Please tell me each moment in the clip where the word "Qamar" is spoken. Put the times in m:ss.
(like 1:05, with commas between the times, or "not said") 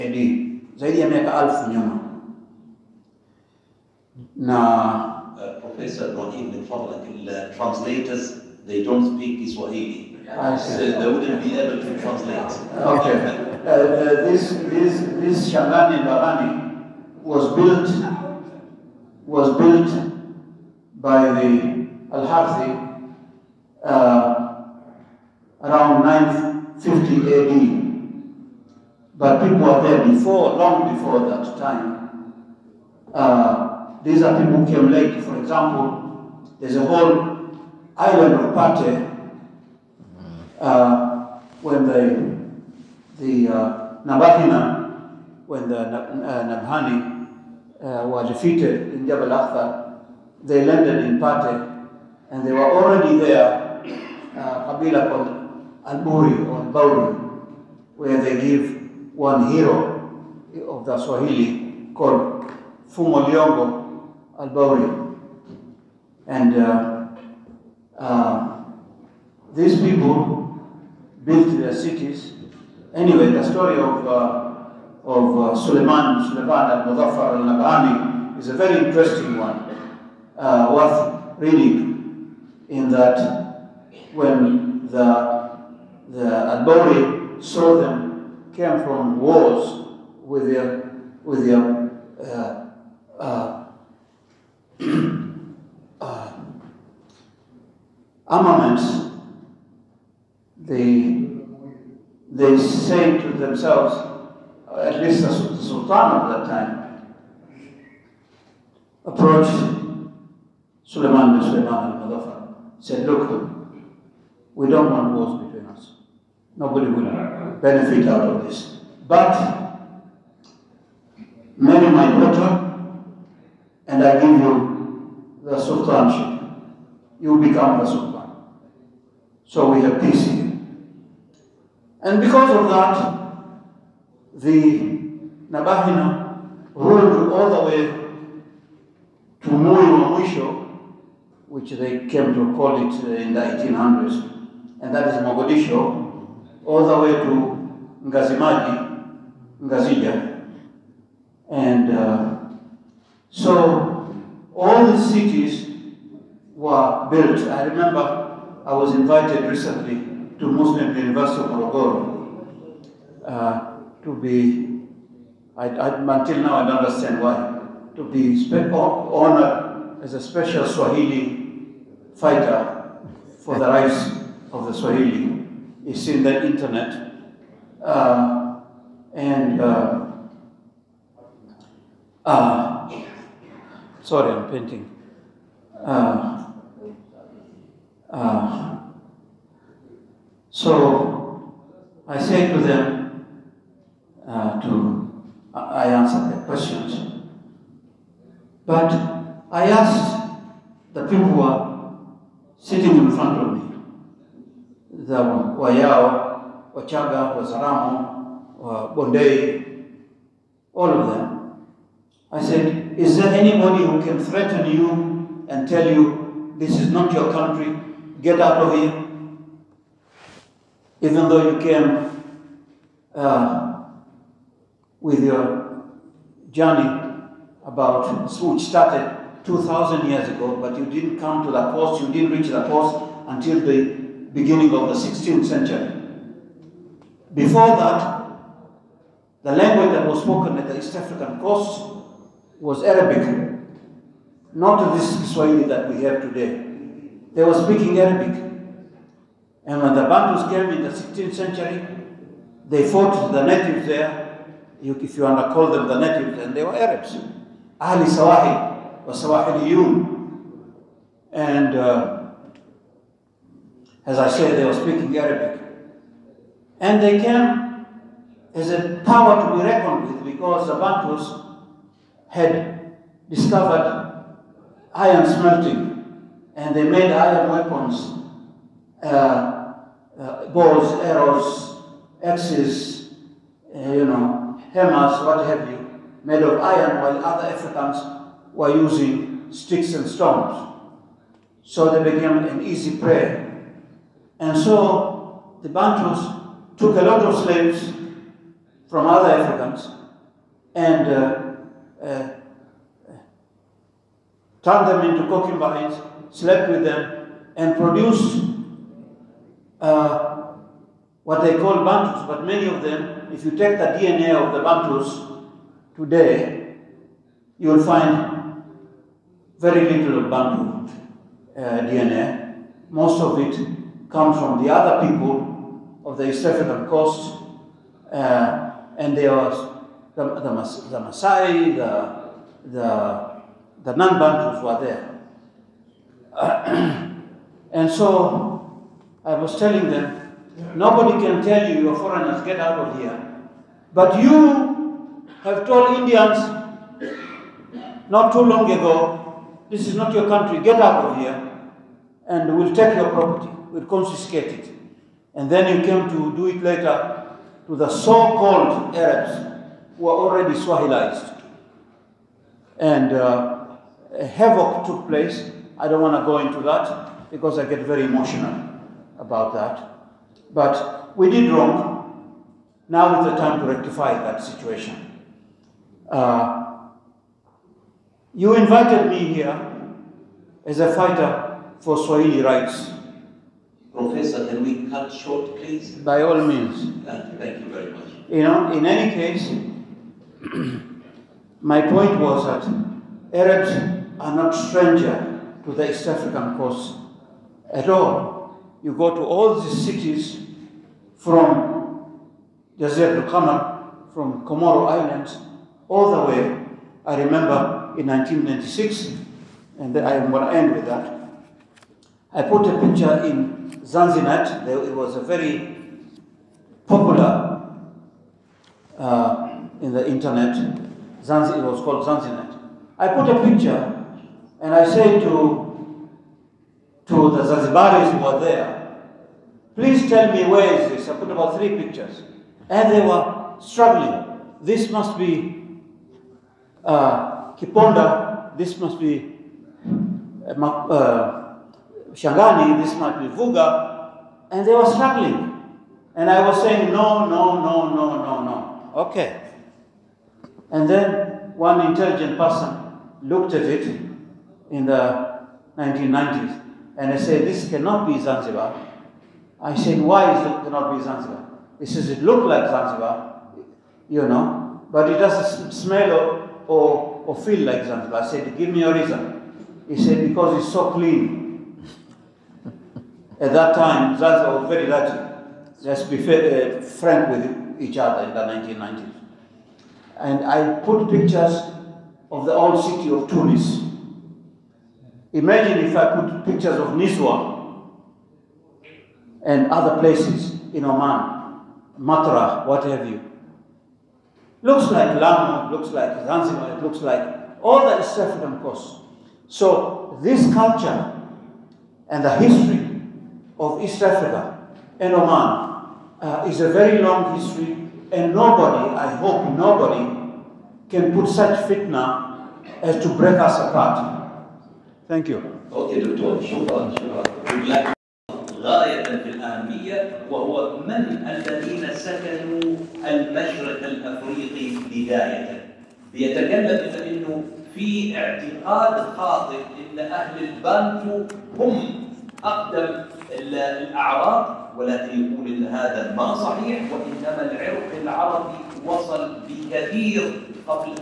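6:43.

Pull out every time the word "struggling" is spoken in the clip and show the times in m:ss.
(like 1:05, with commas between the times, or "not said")
7:13, 7:24.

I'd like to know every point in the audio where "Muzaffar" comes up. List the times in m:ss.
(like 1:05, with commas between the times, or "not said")
1:16, 1:52.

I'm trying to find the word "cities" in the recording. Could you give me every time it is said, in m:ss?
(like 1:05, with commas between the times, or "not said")
1:11, 2:34, 6:39.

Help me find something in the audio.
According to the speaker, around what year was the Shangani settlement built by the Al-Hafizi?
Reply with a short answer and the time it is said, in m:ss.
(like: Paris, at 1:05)
950 AD, at 0:26.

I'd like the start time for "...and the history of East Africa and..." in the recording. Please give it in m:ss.
8:22.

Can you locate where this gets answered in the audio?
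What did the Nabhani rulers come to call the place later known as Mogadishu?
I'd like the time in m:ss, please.
2:19.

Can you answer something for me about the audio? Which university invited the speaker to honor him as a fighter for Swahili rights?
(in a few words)
Muslim University of Morogoro.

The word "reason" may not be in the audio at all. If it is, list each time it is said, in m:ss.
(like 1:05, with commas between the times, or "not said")
7:48.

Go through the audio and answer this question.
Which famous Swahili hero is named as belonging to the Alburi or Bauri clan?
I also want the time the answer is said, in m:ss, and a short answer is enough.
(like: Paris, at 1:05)
Fumo Liongo, at 1:02.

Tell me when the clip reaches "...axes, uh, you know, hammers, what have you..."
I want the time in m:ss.
4:42.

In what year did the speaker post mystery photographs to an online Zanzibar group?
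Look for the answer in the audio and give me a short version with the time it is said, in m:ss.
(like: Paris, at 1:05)
1996, at 6:48.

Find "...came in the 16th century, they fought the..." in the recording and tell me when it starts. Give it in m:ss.
4:10.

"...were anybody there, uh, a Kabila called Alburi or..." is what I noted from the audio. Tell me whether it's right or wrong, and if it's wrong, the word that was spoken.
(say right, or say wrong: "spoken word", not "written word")
wrong: "already", not "anybody".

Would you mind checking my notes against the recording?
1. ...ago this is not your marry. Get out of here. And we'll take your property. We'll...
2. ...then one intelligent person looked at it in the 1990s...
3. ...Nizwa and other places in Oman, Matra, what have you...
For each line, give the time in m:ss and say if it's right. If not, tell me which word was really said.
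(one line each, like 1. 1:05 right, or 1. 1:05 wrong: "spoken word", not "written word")
1. 5:48 wrong: "country", not "marry"
2. 7:30 right
3. 8:06 right.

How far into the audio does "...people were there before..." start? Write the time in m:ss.
0:29.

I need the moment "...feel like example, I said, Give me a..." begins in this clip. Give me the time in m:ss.
7:47.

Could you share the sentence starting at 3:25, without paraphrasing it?
Za Wayao, Wachaga, Wazaramo, Bondei, all of them.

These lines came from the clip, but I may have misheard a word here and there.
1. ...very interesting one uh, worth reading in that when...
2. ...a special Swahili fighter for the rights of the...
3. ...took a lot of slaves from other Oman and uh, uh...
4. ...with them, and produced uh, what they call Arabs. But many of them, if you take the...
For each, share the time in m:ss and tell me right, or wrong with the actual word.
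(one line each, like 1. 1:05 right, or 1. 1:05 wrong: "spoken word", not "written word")
1. 1:18 right
2. 2:50 right
3. 4:56 wrong: "Africans", not "Oman"
4. 5:06 wrong: "Bantus", not "Arabs".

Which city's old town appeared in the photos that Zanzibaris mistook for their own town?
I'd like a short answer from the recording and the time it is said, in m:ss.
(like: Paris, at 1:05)
Tunis, at 8:03.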